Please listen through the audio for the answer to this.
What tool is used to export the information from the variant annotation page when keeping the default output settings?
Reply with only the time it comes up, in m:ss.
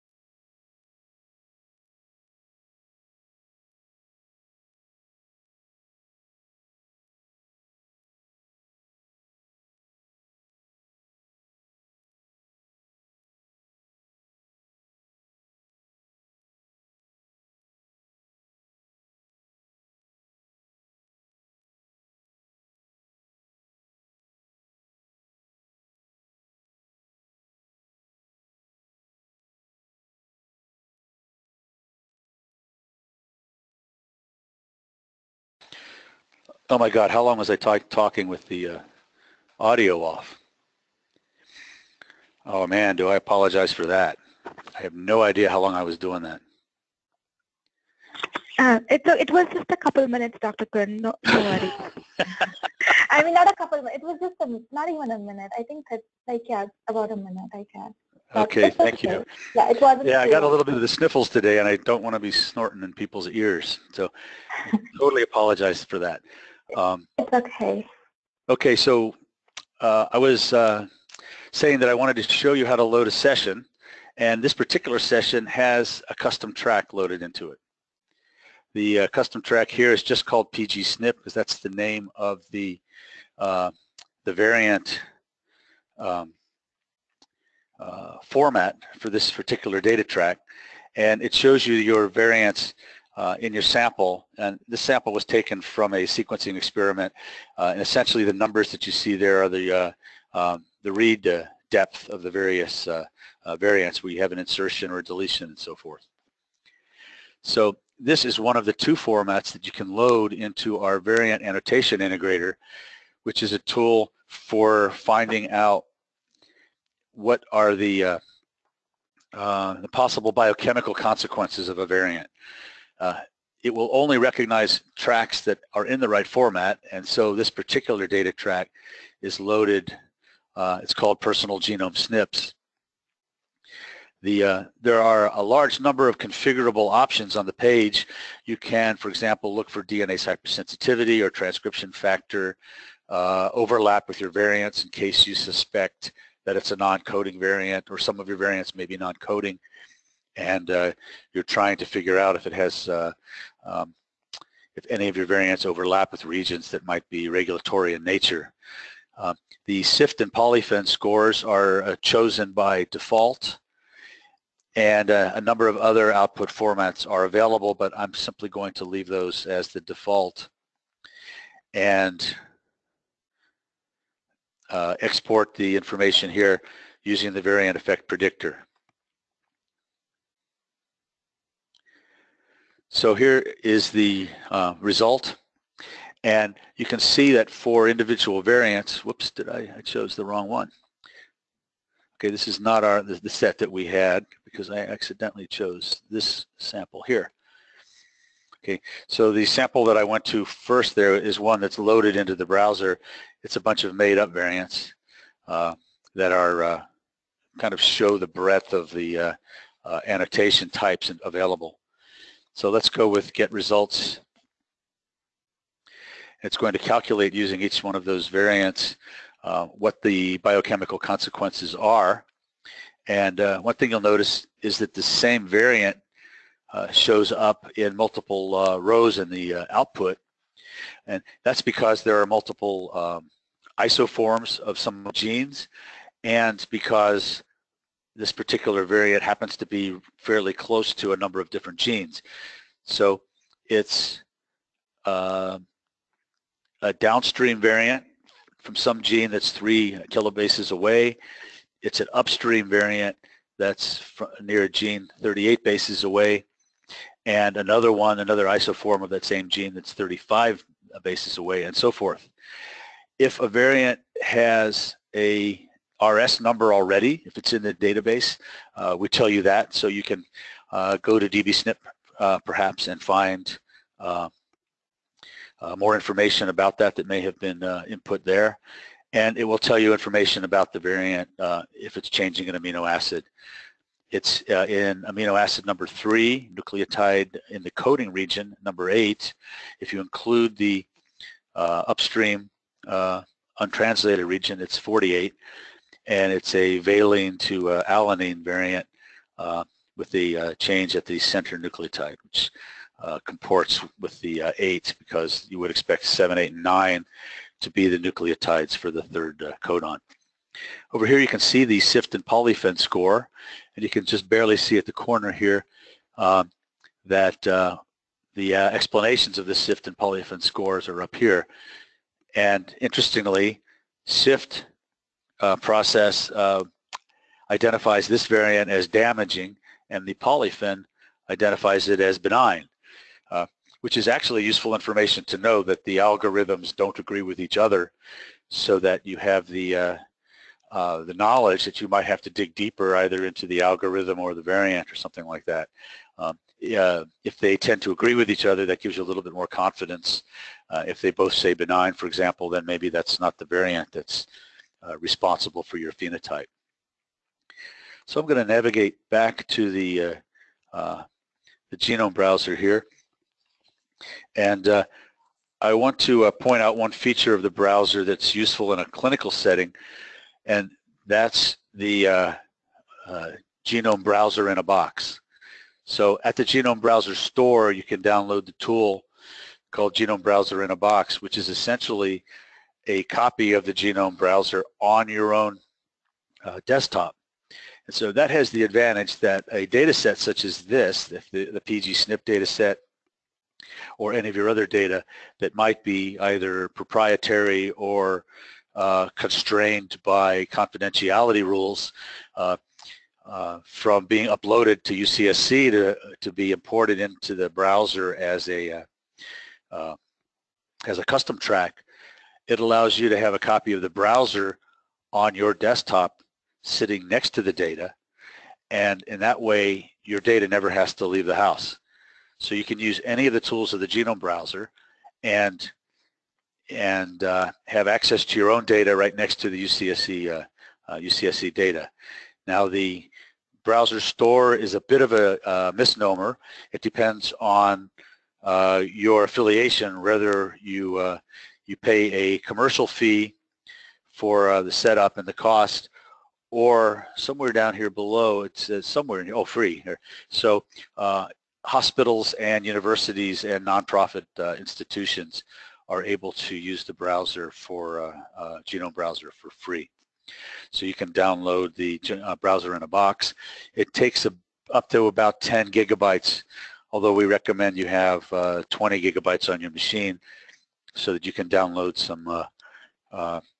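2:57.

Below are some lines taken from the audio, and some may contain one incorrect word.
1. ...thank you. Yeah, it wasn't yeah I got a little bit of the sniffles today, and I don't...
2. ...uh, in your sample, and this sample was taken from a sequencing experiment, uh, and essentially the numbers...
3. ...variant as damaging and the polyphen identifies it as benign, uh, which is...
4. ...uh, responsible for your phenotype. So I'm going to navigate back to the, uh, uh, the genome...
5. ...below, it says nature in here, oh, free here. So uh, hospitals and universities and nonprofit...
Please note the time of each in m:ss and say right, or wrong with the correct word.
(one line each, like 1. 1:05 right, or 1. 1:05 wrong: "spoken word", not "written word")
1. 0:58 right
2. 1:33 right
3. 5:28 right
4. 5:54 right
5. 7:27 wrong: "somewhere", not "nature".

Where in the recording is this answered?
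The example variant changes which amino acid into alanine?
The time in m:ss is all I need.
4:56.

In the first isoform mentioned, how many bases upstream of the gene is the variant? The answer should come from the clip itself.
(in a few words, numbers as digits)
38 bases.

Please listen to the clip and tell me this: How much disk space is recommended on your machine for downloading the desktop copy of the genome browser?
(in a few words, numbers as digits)
20 gigabytes.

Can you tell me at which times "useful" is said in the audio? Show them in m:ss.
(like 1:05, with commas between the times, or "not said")
5:34, 6:08.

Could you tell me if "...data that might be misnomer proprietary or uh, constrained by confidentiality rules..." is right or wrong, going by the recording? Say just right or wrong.
wrong.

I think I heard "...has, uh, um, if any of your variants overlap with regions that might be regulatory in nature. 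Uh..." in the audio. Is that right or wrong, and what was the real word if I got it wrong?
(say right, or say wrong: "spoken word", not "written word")
right.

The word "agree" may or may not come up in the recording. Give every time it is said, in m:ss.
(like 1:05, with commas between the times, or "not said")
5:36, 5:47.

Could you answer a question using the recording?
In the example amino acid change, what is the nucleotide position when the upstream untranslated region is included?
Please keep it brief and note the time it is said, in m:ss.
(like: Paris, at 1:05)
48, at 4:54.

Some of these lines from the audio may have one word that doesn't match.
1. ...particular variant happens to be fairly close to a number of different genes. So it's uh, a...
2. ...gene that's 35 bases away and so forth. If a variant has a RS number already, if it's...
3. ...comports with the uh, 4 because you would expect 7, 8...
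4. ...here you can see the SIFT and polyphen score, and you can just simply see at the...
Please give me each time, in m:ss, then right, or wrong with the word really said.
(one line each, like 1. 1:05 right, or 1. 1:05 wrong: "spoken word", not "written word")
1. 3:58 right
2. 4:19 right
3. 5:03 wrong: "8", not "4"
4. 5:11 wrong: "barely", not "simply".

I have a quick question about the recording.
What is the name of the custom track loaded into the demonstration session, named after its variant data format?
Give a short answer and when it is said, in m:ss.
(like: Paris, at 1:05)
pgSNP, at 1:20.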